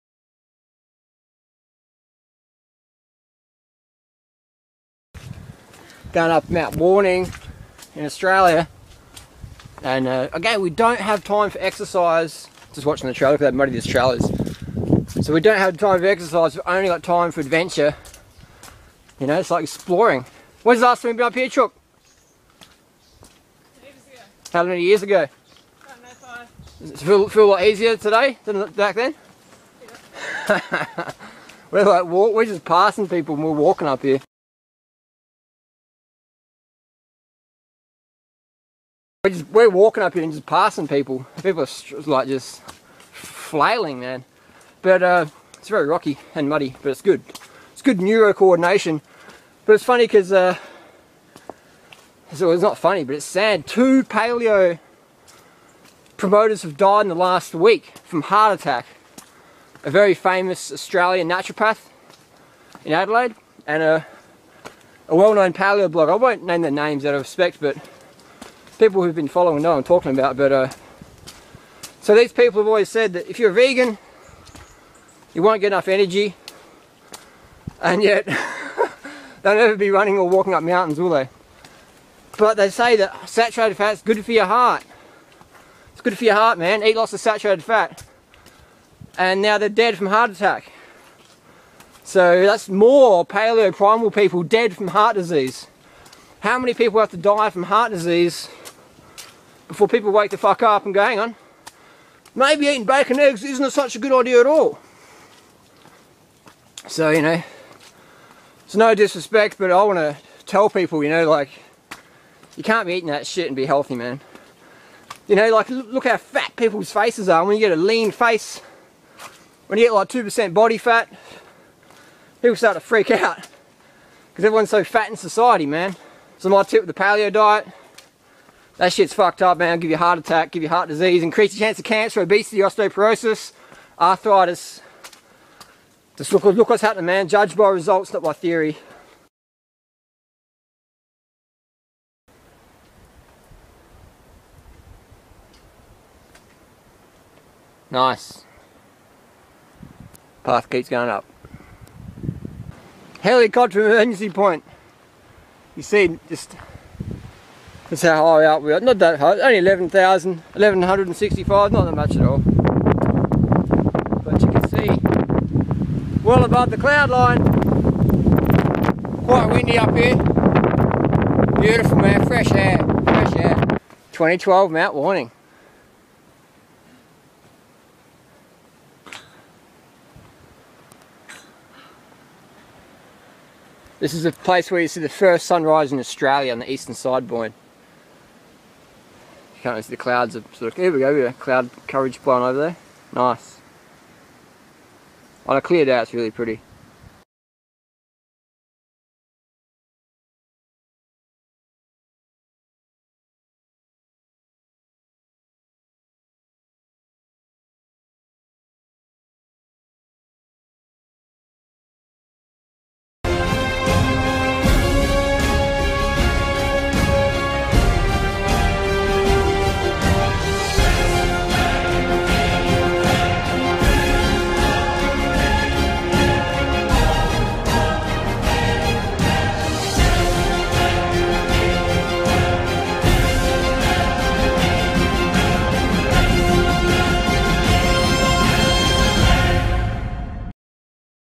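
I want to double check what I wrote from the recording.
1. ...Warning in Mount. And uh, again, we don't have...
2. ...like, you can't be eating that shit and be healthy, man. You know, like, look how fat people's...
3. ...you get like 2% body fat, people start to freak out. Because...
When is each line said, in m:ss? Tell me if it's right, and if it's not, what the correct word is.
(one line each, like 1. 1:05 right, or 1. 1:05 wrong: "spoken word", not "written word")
1. 0:06 wrong: "Australia", not "Mount"
2. 1:51 right
3. 1:59 right.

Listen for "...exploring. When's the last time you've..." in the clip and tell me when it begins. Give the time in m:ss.
0:19.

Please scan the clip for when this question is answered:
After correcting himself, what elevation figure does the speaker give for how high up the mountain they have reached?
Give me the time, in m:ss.
2:40.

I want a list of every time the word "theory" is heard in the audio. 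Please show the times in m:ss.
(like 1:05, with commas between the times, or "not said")
2:18.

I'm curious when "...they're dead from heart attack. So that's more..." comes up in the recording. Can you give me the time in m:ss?
1:29.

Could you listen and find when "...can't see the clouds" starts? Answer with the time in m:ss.
3:09.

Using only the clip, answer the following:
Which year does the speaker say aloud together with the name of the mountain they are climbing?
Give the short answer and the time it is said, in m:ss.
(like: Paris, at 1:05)
2012, at 2:54.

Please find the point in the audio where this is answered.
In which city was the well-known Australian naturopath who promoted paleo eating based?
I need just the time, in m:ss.
1:02.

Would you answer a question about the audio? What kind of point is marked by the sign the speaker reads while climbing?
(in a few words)
Helicopter emergency point.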